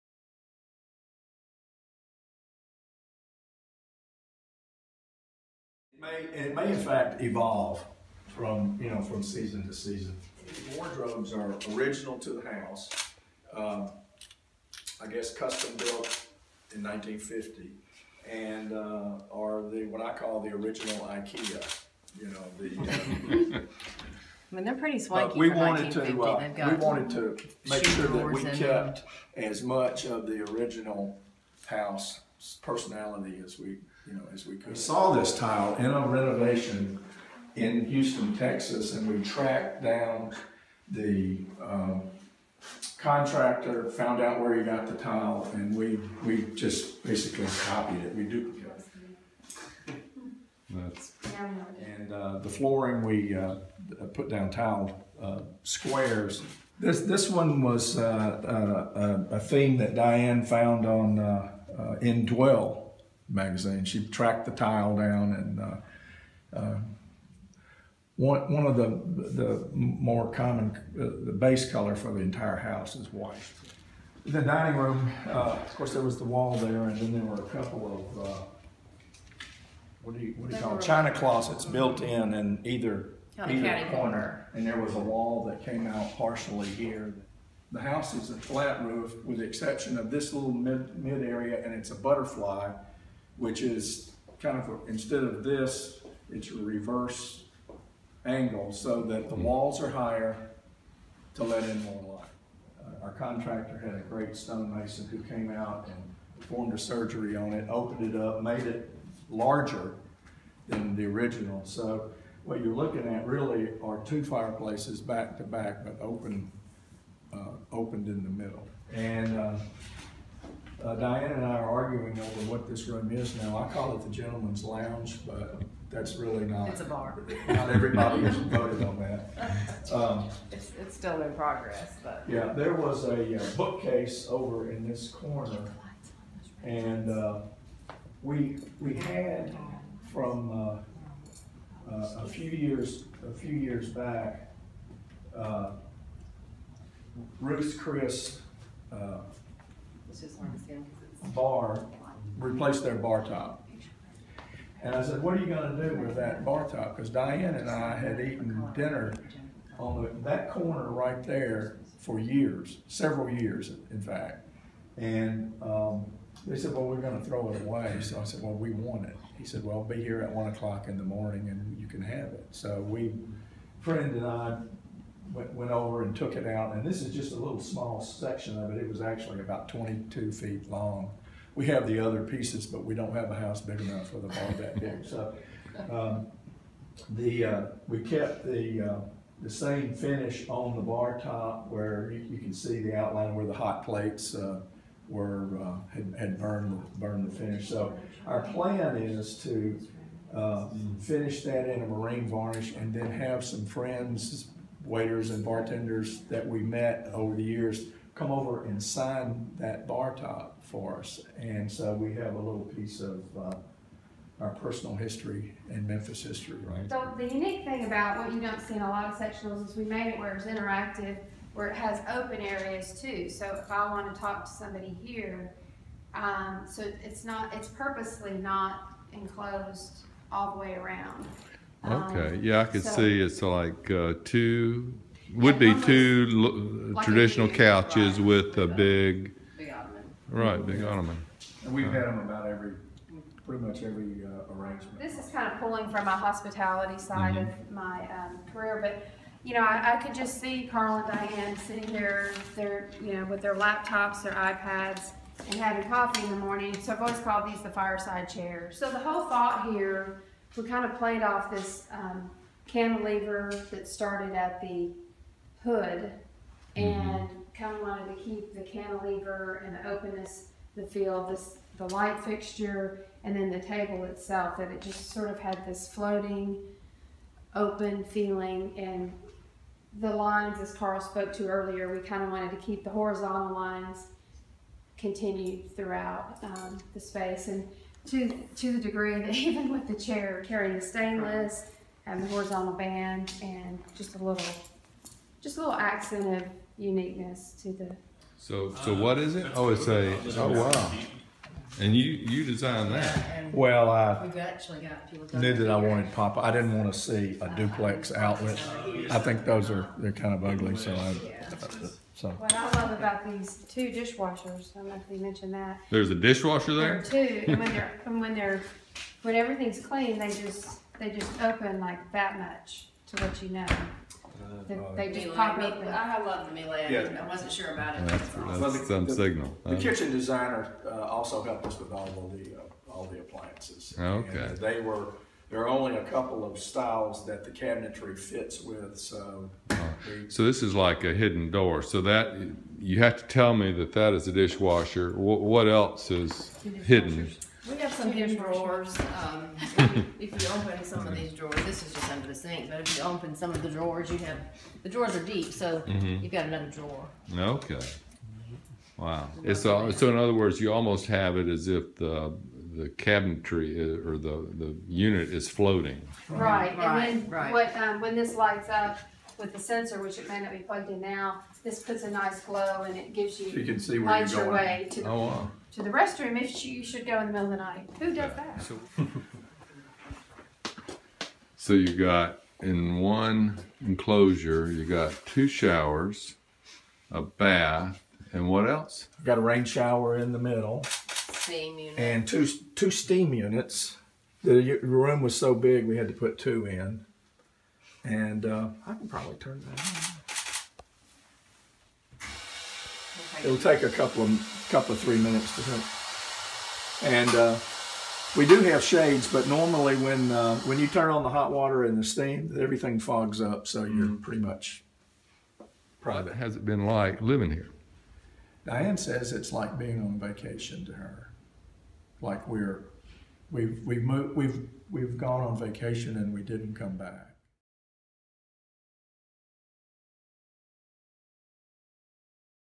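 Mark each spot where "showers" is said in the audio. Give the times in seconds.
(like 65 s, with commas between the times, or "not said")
385 s, 389 s.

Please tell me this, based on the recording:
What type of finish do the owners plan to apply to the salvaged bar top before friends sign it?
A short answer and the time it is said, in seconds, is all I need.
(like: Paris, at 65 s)
Marine varnish, at 201 s.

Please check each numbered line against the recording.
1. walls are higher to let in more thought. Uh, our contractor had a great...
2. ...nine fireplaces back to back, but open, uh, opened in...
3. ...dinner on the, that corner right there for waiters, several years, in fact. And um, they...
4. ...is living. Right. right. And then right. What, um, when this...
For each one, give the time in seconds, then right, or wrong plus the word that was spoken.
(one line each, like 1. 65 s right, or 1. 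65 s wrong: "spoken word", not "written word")
1. 99 s wrong: "light", not "thought"
2. 114 s wrong: "two", not "nine"
3. 158 s wrong: "years", not "waiters"
4. 365 s wrong: "floating", not "living".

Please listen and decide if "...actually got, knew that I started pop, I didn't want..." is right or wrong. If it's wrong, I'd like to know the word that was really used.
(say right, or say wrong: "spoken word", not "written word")
wrong: "wanted", not "started".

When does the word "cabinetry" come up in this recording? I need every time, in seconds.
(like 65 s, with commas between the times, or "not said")
337 s, 363 s.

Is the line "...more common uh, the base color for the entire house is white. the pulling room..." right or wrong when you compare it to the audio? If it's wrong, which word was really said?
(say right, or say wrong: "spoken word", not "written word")
wrong: "dining", not "pulling".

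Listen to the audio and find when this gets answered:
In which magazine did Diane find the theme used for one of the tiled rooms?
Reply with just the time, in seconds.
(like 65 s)
62 s.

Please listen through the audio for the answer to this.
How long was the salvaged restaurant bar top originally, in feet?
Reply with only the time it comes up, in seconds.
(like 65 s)
179 s.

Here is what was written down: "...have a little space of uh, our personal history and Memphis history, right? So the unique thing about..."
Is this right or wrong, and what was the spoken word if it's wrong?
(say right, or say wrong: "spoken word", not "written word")
wrong: "piece", not "space".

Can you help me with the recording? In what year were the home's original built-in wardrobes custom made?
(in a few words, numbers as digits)
1950.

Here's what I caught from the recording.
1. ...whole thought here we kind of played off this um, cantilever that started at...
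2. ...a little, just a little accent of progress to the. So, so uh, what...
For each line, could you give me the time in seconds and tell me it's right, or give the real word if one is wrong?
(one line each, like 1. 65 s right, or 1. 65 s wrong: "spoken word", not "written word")
1. 259 s right
2. 294 s wrong: "uniqueness", not "progress".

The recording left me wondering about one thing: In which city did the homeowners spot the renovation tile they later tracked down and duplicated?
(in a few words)
Houston, Texas.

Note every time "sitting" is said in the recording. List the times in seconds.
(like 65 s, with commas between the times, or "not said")
251 s.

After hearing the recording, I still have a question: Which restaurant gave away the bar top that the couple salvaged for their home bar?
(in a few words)
Ruth's Chris.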